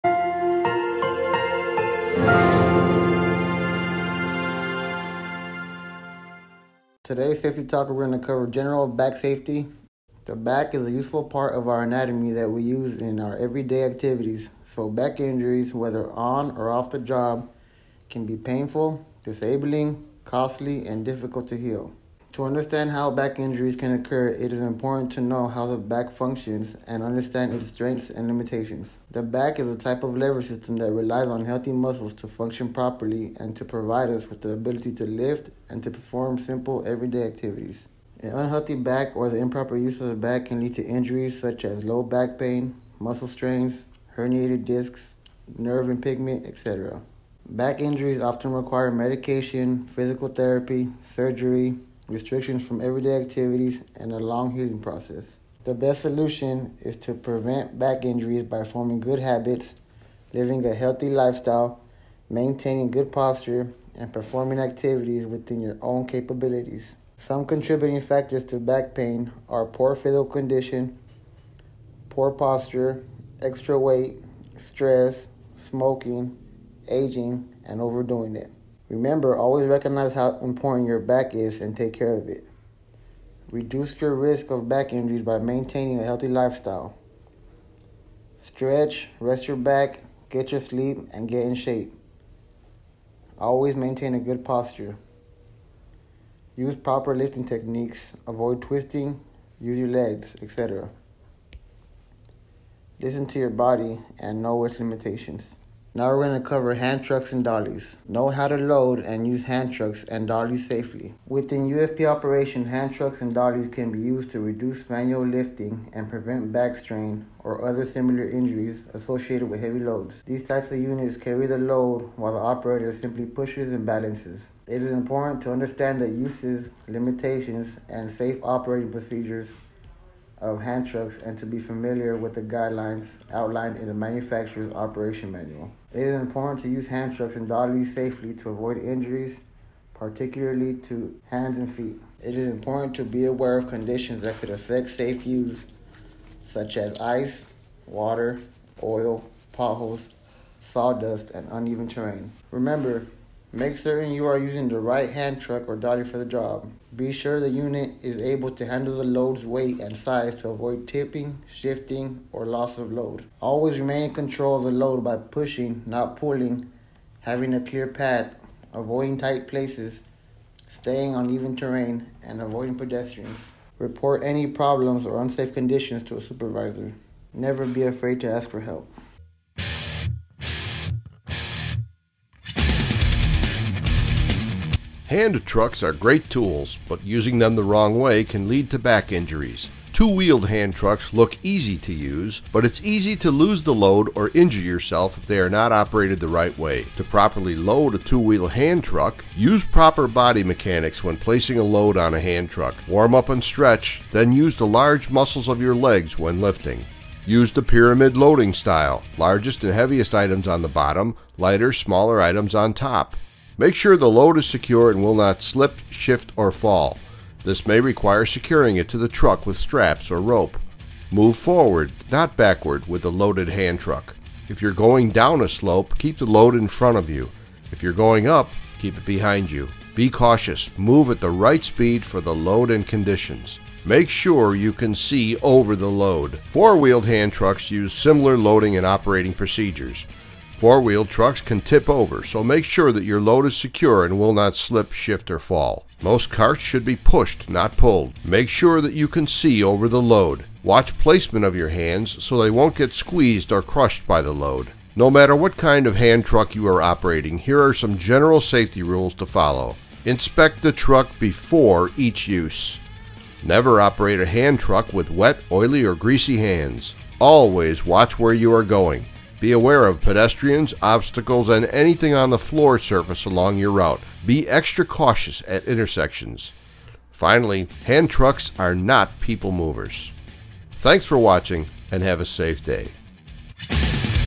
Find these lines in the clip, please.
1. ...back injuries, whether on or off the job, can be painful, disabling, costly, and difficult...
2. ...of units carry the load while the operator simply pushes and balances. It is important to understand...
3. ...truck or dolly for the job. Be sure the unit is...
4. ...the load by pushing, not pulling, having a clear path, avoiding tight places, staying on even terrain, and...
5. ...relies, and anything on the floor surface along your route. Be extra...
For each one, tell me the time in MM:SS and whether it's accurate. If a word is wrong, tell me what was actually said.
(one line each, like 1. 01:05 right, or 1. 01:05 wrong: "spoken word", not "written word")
1. 00:14 right
2. 02:00 right
3. 02:35 right
4. 02:44 right
5. 04:30 wrong: "obstacles", not "relies".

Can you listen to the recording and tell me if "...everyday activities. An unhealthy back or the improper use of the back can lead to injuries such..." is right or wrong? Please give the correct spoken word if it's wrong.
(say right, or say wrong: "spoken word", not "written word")
right.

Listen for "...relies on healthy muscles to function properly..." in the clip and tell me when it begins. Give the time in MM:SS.
00:30.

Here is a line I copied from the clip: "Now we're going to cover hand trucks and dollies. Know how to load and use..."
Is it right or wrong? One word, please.
right.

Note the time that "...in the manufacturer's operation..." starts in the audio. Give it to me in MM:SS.
02:13.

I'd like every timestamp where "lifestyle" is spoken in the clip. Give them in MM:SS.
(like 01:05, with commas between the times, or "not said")
01:01, 01:26.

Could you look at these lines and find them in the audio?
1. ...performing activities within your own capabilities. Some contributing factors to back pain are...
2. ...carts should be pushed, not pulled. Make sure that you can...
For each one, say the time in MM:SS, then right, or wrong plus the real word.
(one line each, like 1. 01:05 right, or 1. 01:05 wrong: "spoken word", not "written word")
1. 01:04 right
2. 04:06 right.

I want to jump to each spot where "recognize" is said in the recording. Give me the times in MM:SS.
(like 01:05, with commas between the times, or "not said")
01:19.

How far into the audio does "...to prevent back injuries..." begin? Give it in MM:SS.
00:56.